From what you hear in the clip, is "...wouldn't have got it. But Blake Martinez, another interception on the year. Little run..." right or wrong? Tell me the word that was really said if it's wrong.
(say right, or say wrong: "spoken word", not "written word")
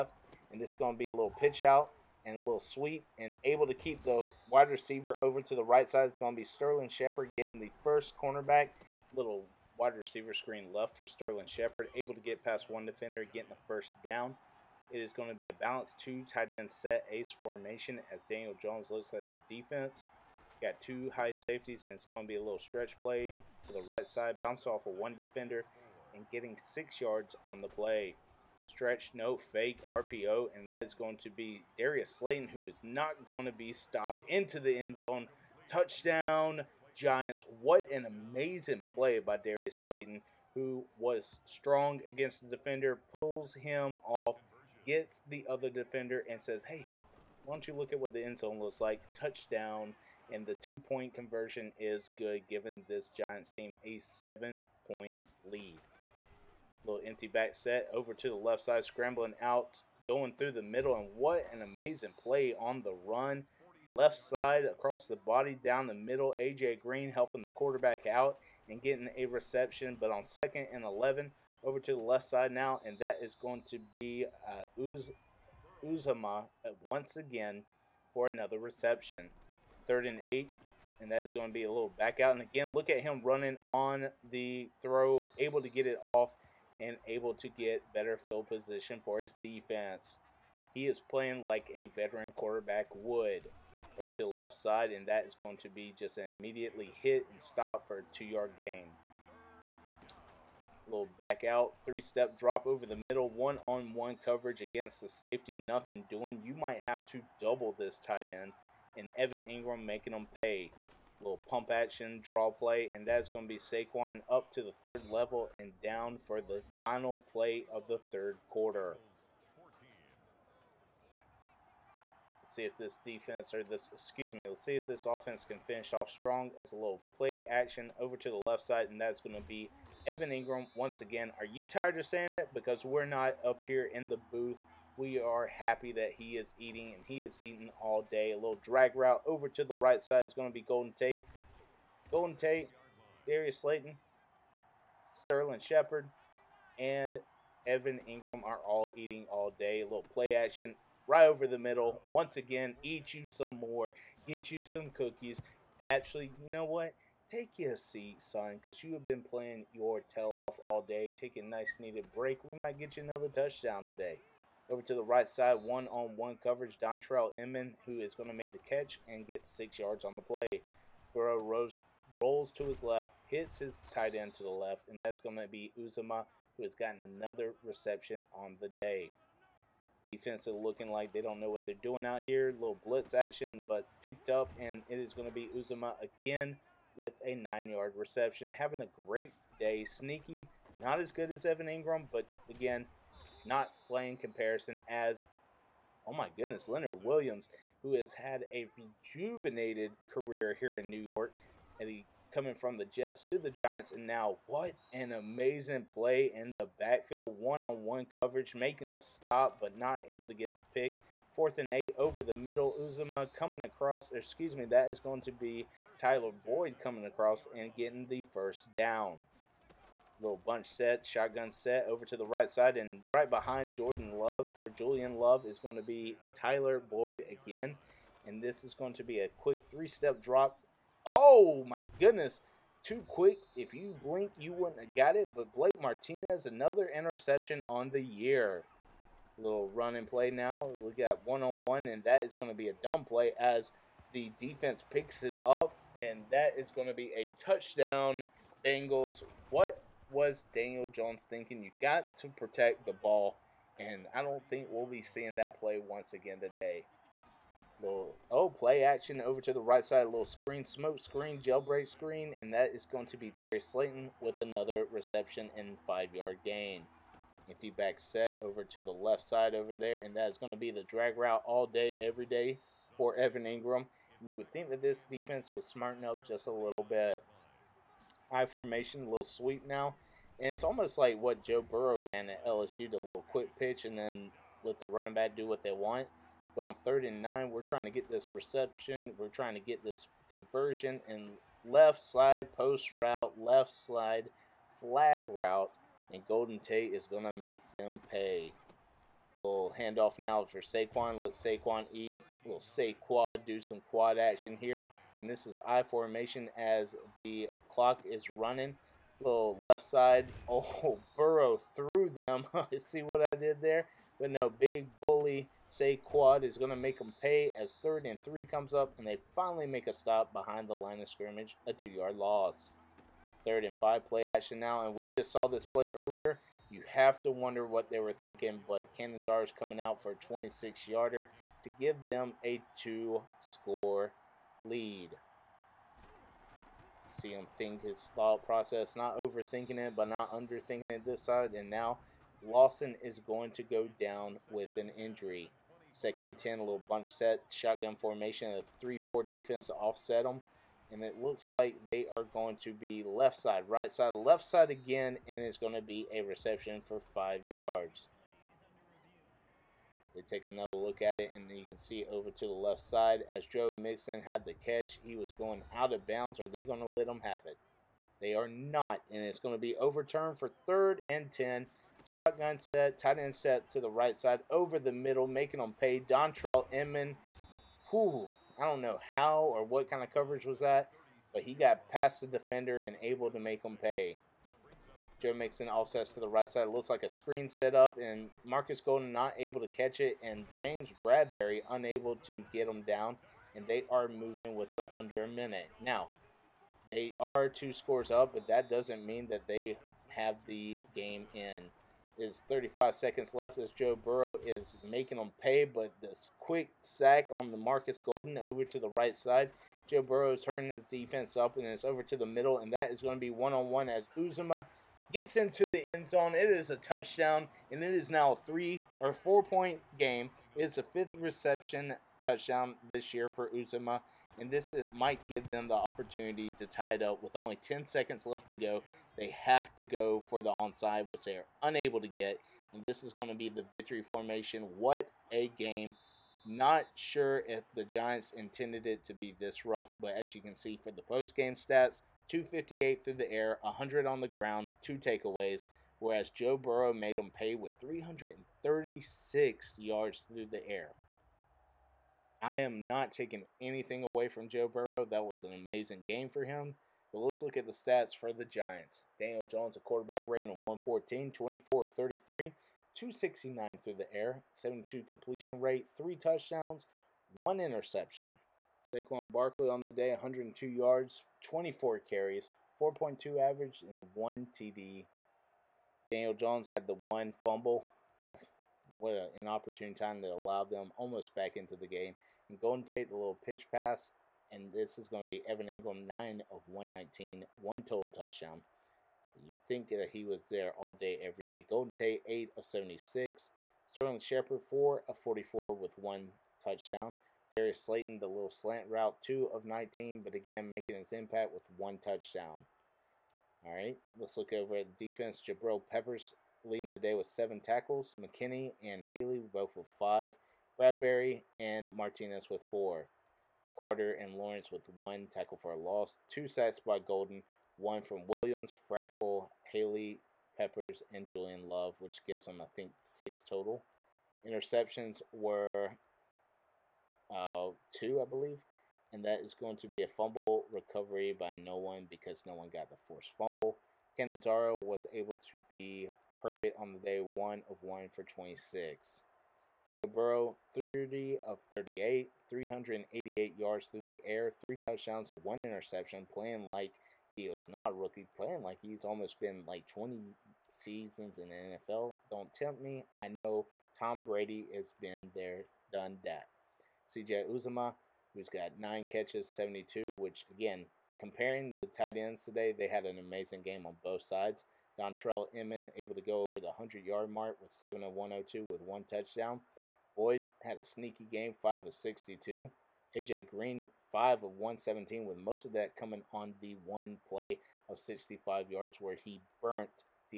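right.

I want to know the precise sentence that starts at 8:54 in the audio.
Canizaro was able to be perfect on the day, one of one for 26.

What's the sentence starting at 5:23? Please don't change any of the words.
Third and five play action now, and we just saw this play earlier.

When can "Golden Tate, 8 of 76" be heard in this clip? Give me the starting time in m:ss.
8:11.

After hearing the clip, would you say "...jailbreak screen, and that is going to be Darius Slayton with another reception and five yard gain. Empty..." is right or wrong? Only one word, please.
right.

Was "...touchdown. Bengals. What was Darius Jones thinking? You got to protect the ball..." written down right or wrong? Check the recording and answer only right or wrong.
wrong.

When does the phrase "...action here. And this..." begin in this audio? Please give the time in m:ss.
5:04.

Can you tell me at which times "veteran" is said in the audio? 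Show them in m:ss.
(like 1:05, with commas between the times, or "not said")
1:31.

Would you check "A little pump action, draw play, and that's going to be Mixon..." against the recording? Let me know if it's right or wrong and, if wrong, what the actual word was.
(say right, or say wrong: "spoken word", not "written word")
wrong: "Saquon", not "Mixon".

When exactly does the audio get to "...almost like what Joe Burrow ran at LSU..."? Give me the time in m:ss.
4:40.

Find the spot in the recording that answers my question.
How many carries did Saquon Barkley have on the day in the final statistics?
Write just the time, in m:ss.
7:51.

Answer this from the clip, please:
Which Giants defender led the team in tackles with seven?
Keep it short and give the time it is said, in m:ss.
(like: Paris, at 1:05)
Jabril Peppers, at 8:25.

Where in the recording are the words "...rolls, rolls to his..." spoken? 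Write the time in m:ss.
2:51.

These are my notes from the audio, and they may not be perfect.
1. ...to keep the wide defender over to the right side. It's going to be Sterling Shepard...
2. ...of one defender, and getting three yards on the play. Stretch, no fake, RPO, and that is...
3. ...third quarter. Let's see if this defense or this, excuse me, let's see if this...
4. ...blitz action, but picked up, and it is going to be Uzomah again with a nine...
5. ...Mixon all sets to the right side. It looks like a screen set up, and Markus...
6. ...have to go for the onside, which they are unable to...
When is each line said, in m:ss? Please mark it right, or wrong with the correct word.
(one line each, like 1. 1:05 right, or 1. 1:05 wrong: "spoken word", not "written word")
1. 0:03 wrong: "receiver", not "defender"
2. 0:24 wrong: "six", not "three"
3. 1:58 right
4. 3:02 right
5. 6:25 right
6. 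7:09 right.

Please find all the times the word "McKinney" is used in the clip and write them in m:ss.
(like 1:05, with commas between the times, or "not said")
8:28.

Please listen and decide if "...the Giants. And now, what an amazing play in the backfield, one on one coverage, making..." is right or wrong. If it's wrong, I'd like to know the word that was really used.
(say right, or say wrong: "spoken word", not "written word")
right.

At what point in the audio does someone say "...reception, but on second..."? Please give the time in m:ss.
1:09.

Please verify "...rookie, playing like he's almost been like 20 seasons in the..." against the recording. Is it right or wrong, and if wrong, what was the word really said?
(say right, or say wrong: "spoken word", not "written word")
right.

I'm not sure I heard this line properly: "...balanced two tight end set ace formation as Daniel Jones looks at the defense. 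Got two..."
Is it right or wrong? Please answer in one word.
right.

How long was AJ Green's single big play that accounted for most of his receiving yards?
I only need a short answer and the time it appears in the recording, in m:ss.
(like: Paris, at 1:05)
65 yards, at 9:37.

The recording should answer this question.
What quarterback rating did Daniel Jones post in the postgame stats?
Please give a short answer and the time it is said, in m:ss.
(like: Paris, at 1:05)
114, at 7:39.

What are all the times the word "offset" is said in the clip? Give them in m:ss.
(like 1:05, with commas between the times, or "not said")
5:49.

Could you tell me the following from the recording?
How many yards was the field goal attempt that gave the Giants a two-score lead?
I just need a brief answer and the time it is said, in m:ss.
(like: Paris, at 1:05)
26, at 5:30.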